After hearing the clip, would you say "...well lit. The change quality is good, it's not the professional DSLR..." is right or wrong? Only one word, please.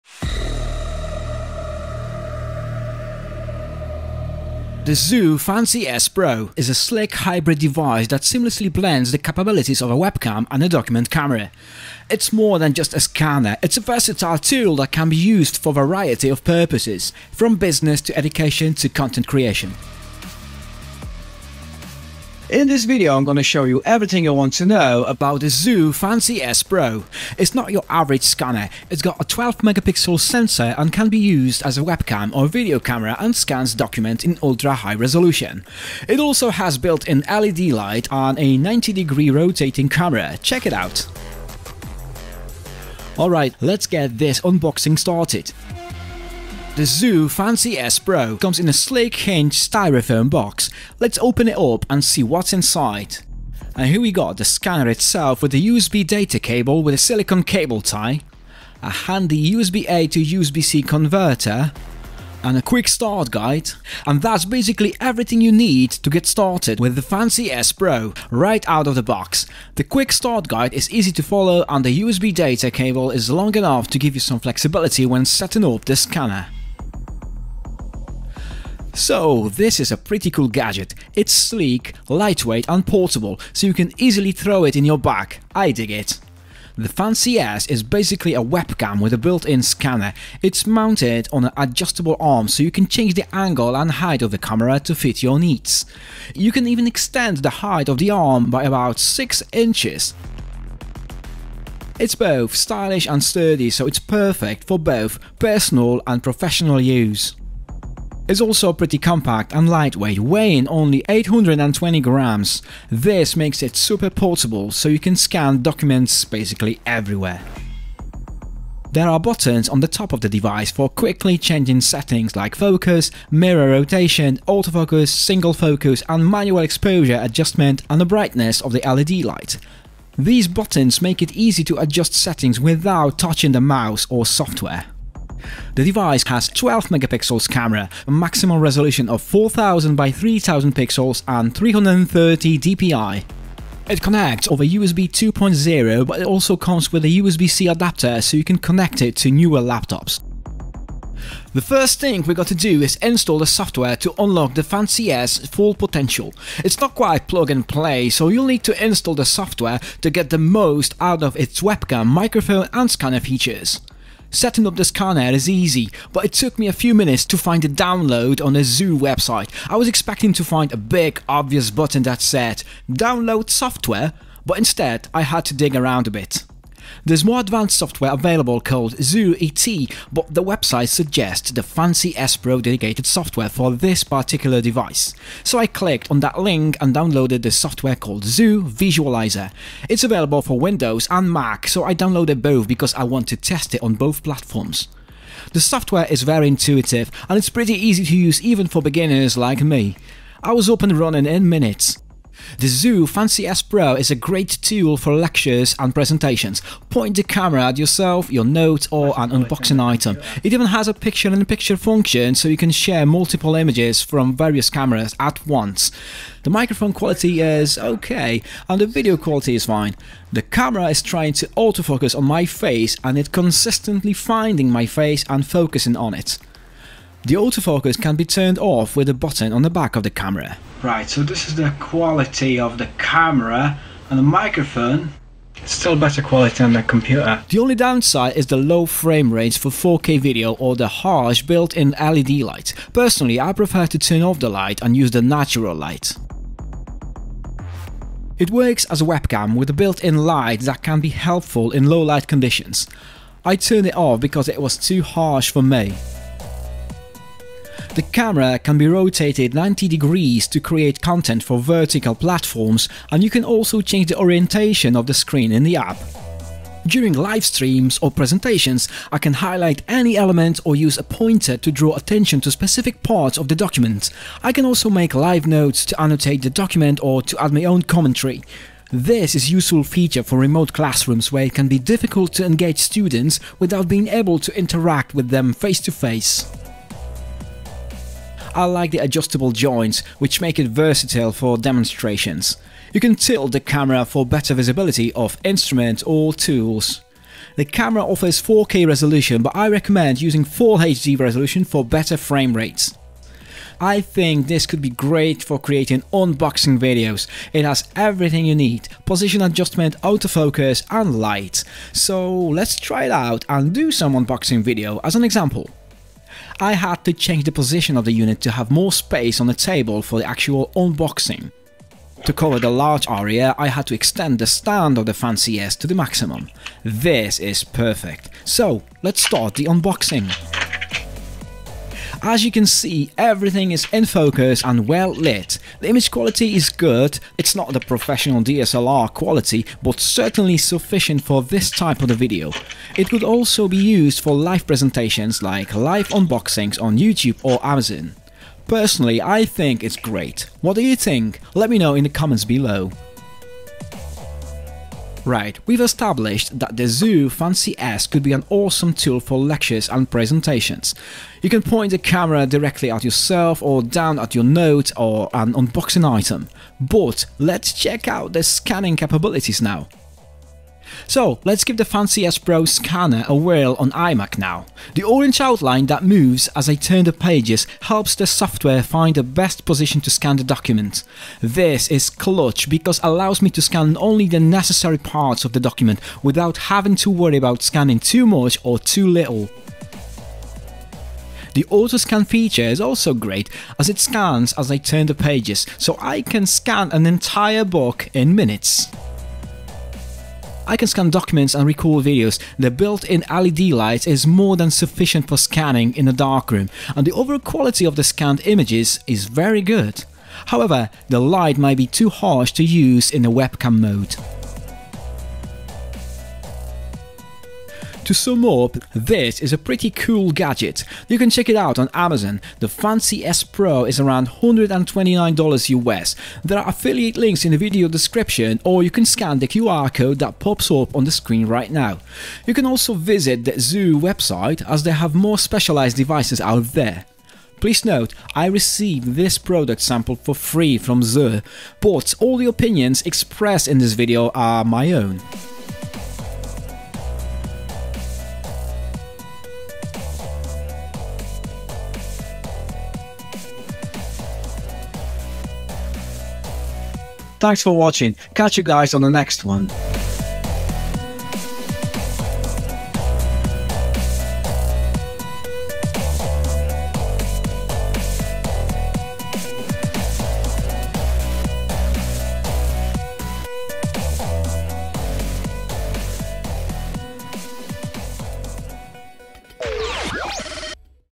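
wrong.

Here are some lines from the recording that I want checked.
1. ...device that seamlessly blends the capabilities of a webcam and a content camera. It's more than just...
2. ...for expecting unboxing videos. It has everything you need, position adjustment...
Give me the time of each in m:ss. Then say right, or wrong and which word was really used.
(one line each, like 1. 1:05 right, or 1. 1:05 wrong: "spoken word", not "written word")
1. 0:07 wrong: "document", not "content"
2. 5:05 wrong: "creating", not "expecting".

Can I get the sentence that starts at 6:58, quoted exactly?
To sum up, this is a pretty cool gadget.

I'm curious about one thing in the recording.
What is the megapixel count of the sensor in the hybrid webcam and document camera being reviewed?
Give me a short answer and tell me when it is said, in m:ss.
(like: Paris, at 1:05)
12, at 0:29.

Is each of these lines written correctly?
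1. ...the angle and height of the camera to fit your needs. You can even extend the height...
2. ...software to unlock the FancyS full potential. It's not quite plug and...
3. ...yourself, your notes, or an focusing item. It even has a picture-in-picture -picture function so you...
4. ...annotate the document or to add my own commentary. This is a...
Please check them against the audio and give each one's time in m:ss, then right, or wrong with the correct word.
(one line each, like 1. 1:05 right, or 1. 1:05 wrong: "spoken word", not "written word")
1. 1:33 right
2. 2:33 right
3. 3:27 wrong: "unboxing", not "focusing"
4. 4:36 right.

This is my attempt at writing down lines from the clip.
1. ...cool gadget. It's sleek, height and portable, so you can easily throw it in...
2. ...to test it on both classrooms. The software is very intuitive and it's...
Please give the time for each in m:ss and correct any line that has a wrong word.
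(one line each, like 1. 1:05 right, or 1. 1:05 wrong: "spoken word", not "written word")
1. 1:20 wrong: "lightweight", not "height"
2. 3:13 wrong: "platforms", not "classrooms".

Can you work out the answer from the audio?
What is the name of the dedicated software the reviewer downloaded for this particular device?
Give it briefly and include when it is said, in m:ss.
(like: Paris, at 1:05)
CZUR Visualizer, at 3:08.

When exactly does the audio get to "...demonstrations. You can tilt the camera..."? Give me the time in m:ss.
4:51.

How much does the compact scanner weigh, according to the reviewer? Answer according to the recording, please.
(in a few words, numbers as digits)
820 grams.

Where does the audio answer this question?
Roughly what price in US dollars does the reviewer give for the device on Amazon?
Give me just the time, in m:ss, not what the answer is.
7:04.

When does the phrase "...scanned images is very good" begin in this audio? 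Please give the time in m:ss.
6:48.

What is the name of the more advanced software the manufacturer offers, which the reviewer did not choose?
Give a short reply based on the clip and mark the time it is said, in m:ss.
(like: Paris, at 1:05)
CZUR ET, at 2:58.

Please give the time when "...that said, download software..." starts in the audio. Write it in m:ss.
2:52.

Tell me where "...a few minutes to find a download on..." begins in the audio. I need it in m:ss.
2:46.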